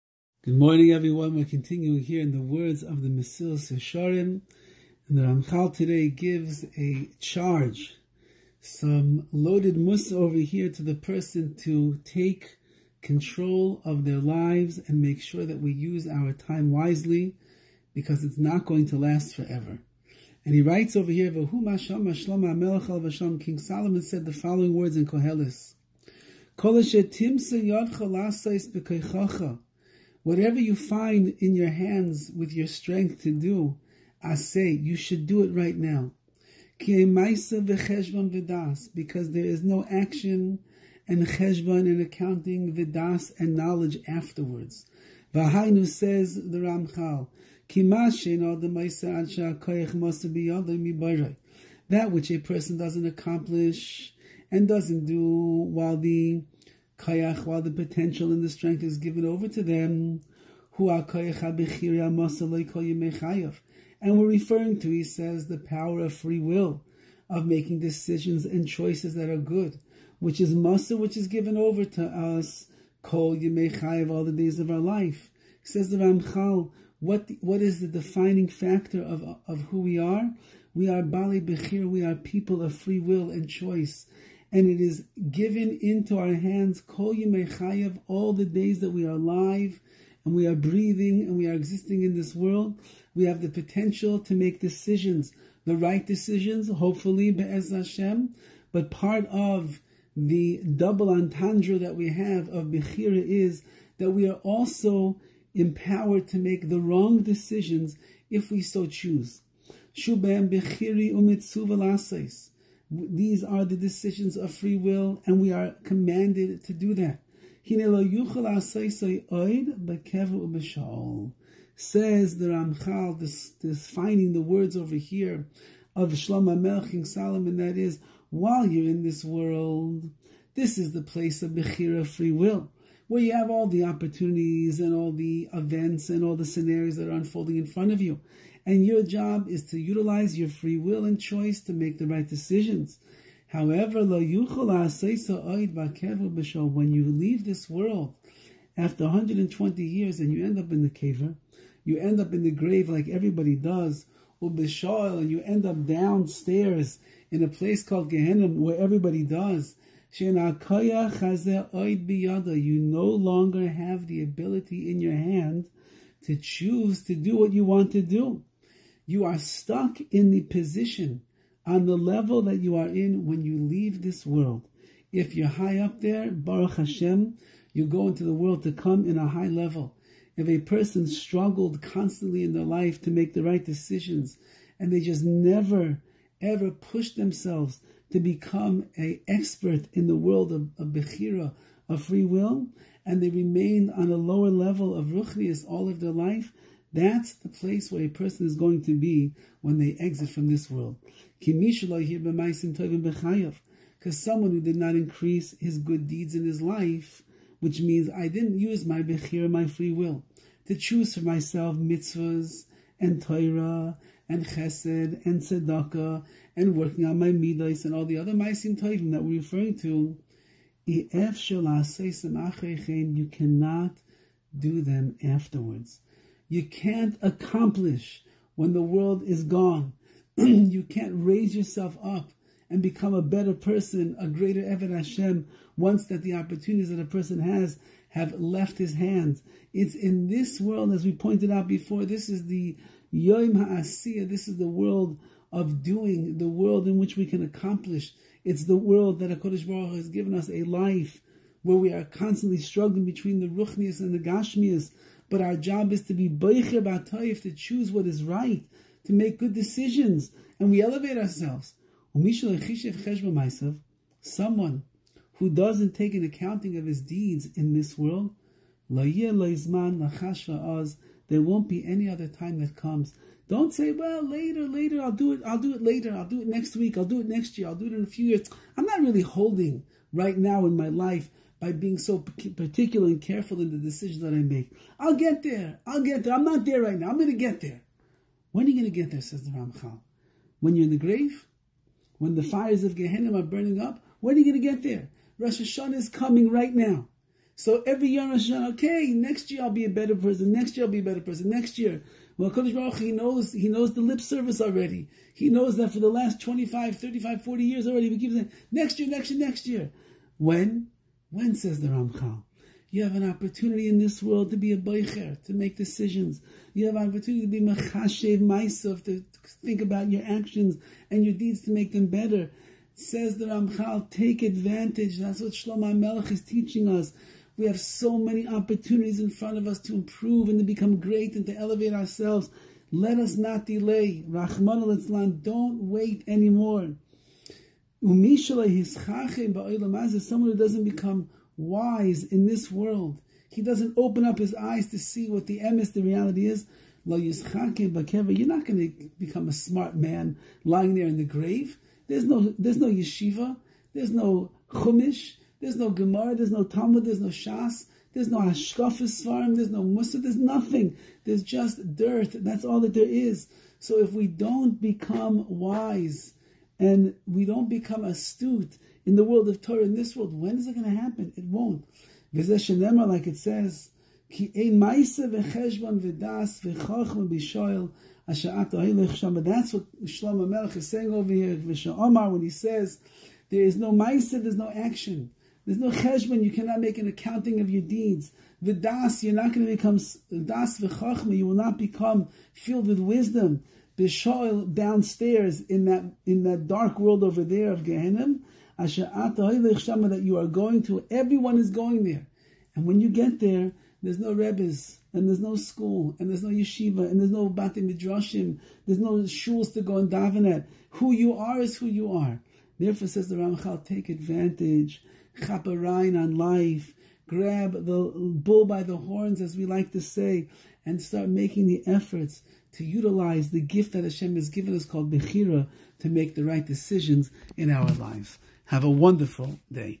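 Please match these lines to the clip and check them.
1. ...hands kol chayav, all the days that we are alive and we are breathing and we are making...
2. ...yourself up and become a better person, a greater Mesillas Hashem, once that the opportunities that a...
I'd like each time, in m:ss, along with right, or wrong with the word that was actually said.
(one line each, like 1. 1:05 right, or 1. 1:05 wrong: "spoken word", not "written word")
1. 1:26 wrong: "existing", not "making"
2. 3:51 wrong: "Eved", not "Mesillas".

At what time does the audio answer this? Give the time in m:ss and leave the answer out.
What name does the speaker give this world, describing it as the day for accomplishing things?
4:03.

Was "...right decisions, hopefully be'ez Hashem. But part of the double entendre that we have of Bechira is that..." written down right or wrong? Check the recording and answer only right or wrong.
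right.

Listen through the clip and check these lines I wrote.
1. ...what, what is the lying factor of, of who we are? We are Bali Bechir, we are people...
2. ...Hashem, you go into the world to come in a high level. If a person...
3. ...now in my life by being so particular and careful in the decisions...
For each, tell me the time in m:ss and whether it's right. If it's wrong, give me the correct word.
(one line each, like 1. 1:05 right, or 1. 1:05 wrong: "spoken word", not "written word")
1. 1:16 wrong: "defining", not "lying"
2. 2:56 right
3. 4:40 right.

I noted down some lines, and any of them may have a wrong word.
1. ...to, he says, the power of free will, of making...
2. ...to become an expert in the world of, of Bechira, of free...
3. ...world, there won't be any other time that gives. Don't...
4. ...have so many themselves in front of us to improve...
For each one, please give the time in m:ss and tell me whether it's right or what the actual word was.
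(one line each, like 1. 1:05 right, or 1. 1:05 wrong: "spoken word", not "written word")
1. 1:04 right
2. 3:08 right
3. 4:27 wrong: "comes", not "gives"
4. 5:27 wrong: "opportunities", not "themselves".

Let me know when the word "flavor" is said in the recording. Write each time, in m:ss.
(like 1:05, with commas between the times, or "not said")
not said.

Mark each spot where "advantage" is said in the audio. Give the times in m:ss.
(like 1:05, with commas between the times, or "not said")
5:24, 6:54.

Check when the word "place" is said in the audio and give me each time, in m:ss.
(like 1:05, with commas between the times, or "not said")
2:11, 2:37, 3:17.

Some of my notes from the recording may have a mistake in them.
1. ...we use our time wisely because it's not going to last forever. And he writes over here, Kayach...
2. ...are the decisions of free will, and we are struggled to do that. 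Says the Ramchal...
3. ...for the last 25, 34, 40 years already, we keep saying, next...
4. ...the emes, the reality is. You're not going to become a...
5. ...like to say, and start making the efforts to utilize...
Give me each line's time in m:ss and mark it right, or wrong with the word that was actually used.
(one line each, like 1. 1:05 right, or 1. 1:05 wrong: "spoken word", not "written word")
1. 0:15 wrong: "King", not "Kayach"
2. 1:53 wrong: "commanded", not "struggled"
3. 5:05 wrong: "35", not "34"
4. 5:45 right
5. 6:59 right.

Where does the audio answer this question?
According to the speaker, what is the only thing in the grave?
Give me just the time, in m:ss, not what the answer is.
6:01.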